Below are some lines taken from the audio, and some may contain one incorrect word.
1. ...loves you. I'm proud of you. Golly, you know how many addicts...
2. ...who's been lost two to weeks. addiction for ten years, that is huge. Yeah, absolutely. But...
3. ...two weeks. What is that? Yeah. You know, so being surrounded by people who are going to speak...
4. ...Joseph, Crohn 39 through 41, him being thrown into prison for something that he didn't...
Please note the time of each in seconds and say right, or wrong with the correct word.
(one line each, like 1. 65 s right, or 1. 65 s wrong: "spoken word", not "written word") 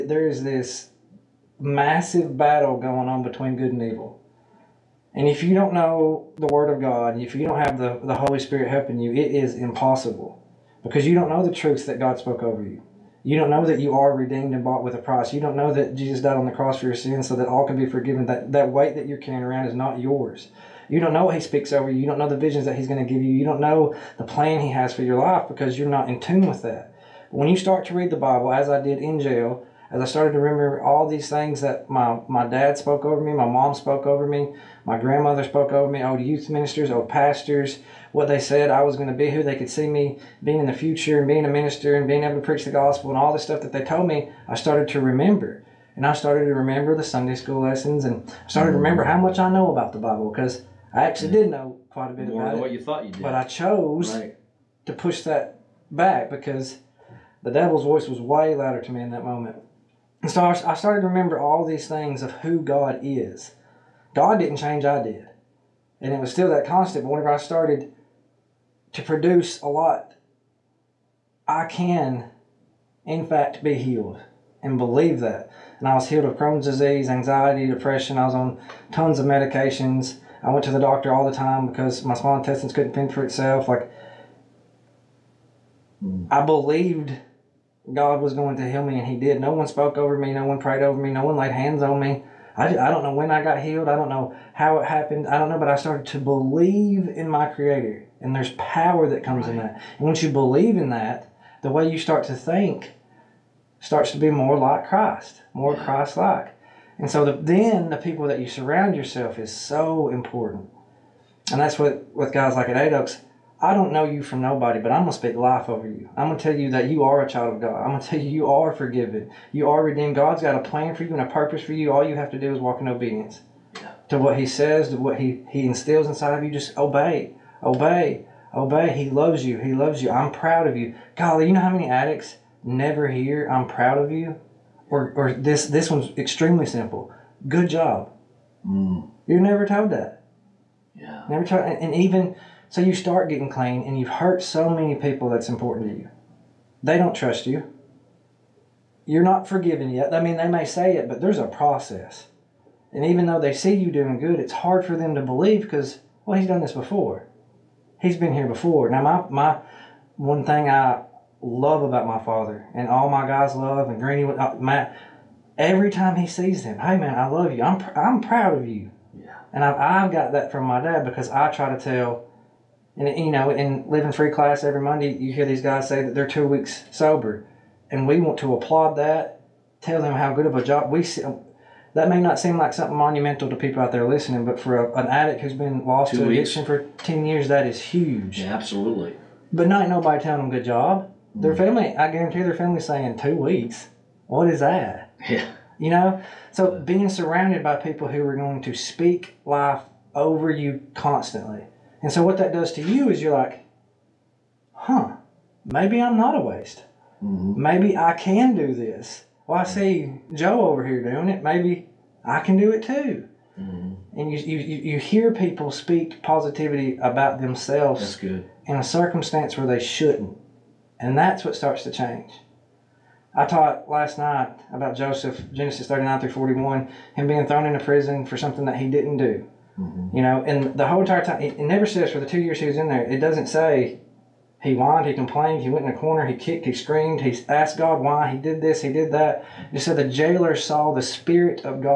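1. 129 s right
2. 185 s right
3. 193 s right
4. 224 s wrong: "Genesis", not "Crohn".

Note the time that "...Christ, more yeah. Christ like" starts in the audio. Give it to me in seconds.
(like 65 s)
104 s.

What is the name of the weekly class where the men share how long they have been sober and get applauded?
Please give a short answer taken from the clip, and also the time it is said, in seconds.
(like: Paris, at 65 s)
Living Free class, at 173 s.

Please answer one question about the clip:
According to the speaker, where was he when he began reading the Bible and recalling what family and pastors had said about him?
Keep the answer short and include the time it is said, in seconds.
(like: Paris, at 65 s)
In jail, at 28 s.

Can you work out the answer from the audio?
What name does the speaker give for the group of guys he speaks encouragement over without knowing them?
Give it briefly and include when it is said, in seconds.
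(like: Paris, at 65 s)
Eight Oaks, at 112 s.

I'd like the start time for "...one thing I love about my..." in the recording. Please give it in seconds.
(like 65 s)
160 s.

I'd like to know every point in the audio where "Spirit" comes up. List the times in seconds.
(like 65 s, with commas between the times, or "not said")
8 s, 241 s.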